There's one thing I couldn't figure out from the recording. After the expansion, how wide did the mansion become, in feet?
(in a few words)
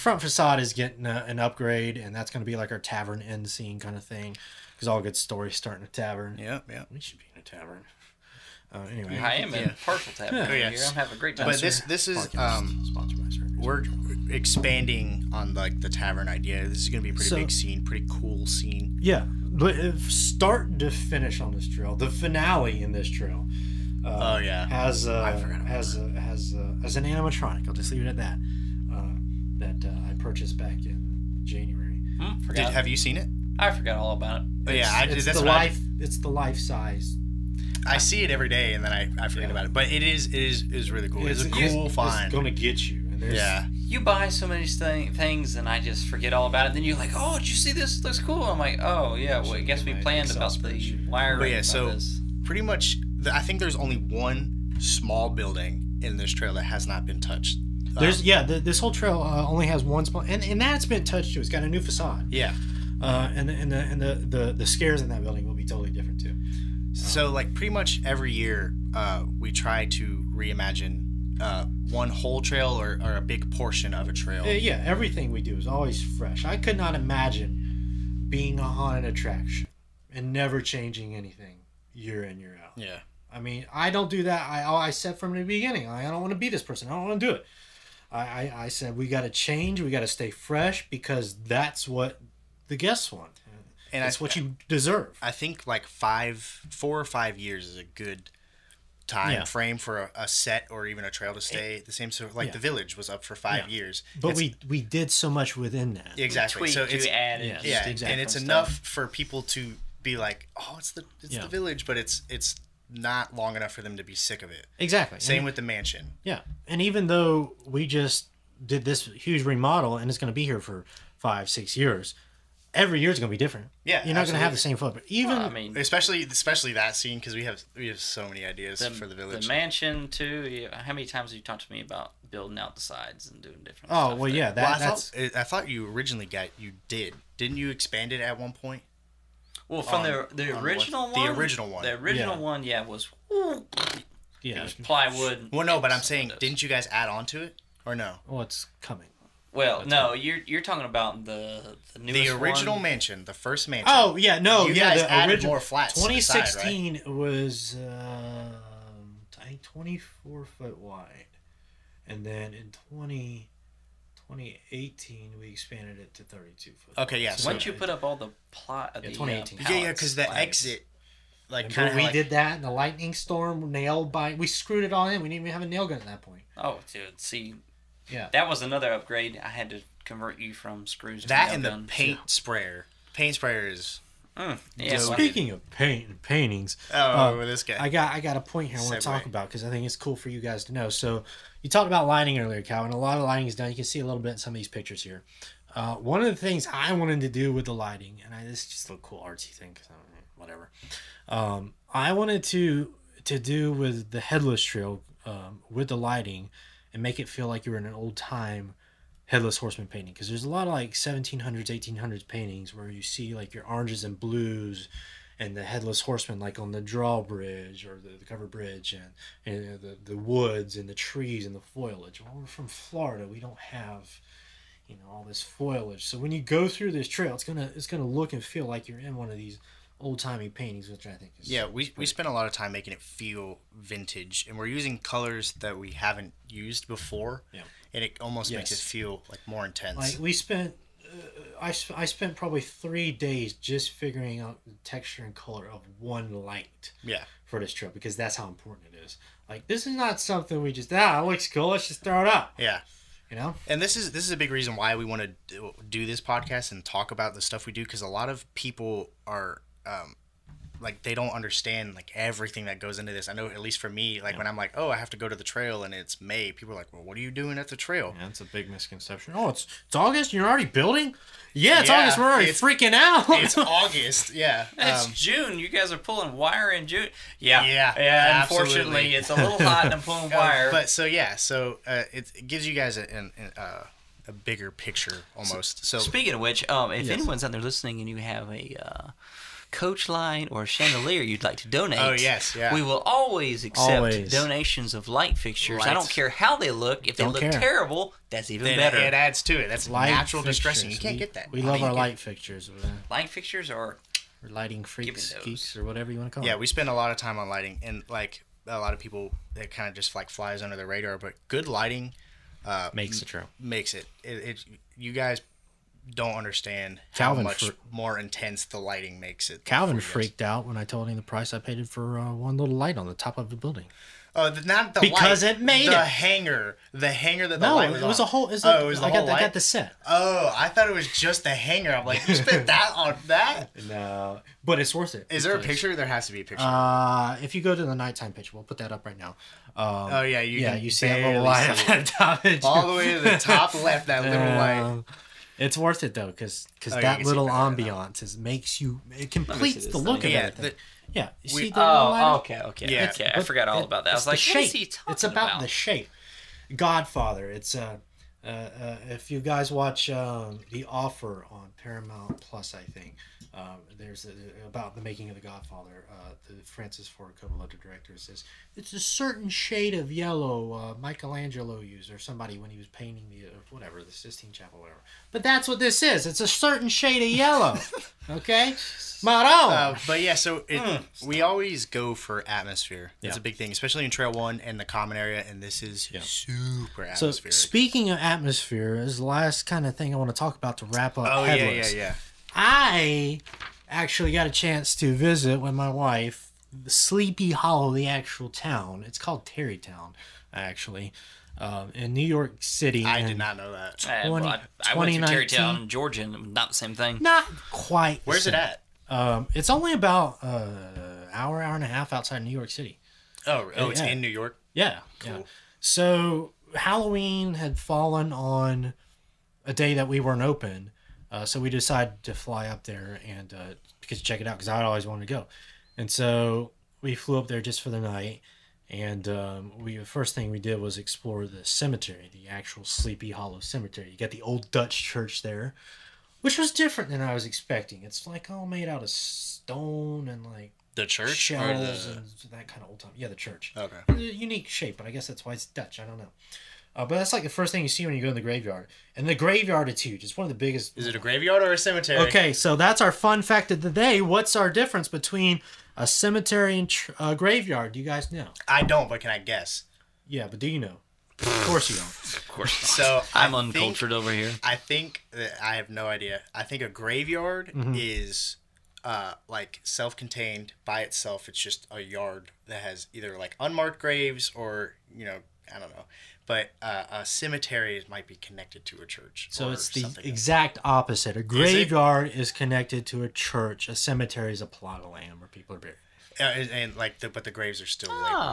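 32 feet.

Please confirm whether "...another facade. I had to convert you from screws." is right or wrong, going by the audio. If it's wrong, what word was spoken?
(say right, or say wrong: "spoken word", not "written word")
wrong: "upgrade", not "facade".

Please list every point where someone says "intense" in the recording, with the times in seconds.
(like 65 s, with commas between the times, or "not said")
239 s, 318 s.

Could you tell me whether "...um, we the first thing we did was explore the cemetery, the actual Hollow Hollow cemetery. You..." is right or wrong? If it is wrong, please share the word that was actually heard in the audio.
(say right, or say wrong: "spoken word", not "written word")
wrong: "Sleepy", not "Hollow".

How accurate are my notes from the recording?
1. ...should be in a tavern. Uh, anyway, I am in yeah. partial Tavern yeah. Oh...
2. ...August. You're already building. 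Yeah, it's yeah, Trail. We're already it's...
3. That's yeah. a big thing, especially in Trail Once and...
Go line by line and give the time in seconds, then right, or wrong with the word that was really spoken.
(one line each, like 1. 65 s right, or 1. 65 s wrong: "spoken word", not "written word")
1. 7 s right
2. 269 s wrong: "August", not "Trail"
3. 383 s wrong: "One", not "Once".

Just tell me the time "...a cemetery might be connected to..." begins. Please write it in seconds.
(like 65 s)
477 s.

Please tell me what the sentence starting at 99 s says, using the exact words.
frame for a, a, set or even a trail to stay it, eh, the same So like yeah.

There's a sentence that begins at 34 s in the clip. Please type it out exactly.
But oh, yeah, I, it's the life.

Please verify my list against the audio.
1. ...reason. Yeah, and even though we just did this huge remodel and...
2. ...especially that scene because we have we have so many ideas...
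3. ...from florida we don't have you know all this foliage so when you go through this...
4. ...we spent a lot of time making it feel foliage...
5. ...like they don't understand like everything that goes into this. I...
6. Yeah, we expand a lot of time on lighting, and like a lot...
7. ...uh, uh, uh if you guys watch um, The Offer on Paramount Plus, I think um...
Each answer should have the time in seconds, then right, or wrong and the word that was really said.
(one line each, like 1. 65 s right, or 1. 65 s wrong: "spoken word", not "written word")
1. 115 s wrong: "mansion", not "reason"
2. 126 s right
3. 222 s right
4. 231 s wrong: "vintage", not "foliage"
5. 260 s right
6. 306 s wrong: "spend", not "expand"
7. 357 s right.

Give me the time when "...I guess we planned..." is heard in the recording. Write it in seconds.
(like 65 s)
49 s.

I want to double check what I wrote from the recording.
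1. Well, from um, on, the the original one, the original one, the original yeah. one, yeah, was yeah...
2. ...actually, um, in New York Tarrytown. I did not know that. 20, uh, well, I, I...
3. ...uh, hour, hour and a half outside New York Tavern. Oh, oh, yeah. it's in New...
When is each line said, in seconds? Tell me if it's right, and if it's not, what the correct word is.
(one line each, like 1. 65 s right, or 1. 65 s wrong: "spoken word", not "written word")
1. 139 s right
2. 400 s wrong: "City", not "Tarrytown"
3. 410 s wrong: "City", not "Tavern".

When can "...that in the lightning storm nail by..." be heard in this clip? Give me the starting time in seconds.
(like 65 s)
172 s.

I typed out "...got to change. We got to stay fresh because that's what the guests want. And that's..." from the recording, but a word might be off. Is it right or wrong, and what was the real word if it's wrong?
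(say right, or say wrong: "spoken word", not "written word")
right.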